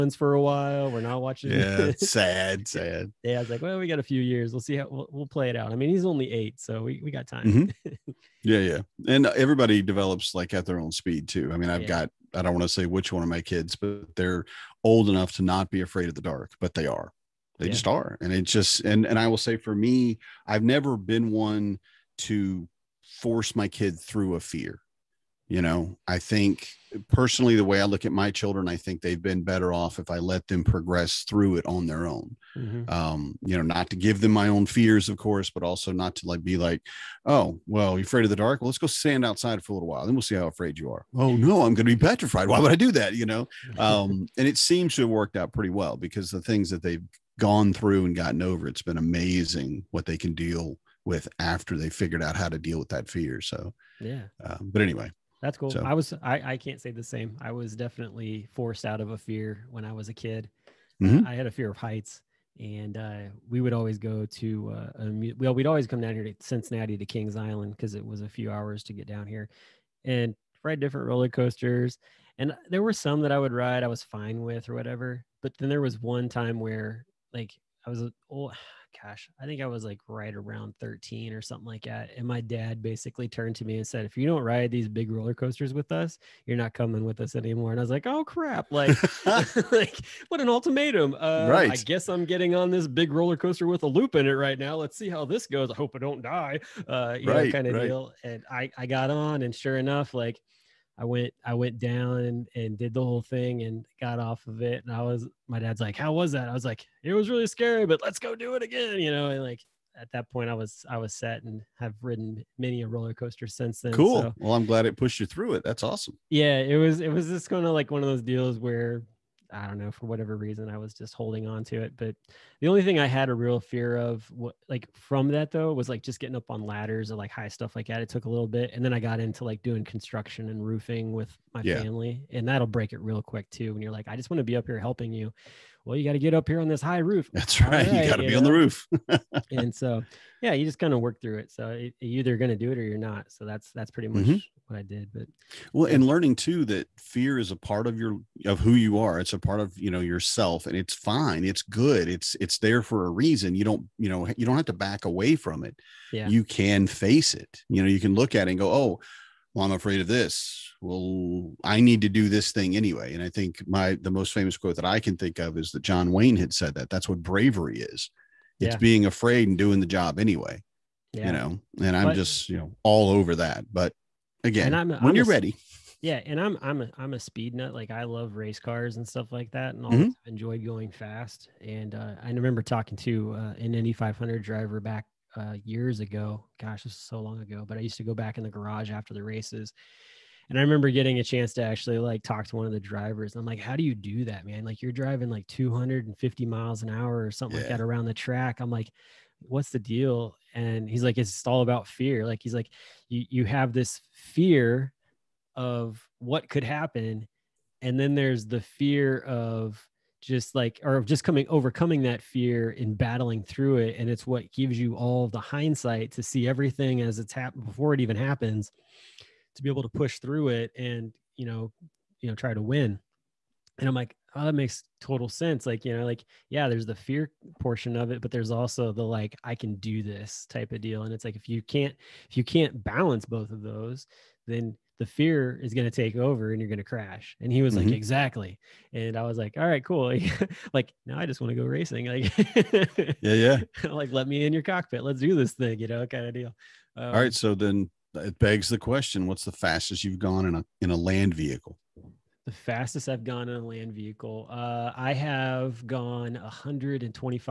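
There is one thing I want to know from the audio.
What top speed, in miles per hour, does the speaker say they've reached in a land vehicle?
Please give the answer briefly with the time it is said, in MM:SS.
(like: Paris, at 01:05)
125, at 04:16.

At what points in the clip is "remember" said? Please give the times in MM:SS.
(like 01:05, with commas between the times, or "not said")
03:02, 03:10.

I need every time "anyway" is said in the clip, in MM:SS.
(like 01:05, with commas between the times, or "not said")
00:54, 02:42, 02:50.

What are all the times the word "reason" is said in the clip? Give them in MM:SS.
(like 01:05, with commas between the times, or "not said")
02:00, 02:33.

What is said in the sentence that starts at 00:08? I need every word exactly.
yeah yeah and everybody develops like at their own speed too i mean i've yeah.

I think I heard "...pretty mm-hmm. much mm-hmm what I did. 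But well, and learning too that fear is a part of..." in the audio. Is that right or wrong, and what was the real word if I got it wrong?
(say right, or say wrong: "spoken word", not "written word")
right.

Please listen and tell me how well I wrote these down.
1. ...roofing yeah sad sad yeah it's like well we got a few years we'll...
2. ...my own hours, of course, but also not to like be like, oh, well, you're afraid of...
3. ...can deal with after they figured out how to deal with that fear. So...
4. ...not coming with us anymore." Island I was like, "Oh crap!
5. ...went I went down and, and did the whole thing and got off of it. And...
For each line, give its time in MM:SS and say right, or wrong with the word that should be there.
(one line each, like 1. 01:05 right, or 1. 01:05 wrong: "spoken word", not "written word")
1. 00:01 wrong: "watching", not "roofing"
2. 00:34 wrong: "fears", not "hours"
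3. 00:50 right
4. 01:26 wrong: "And", not "Island"
5. 01:41 right.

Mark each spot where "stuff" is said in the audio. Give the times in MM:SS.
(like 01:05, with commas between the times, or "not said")
02:07, 02:59.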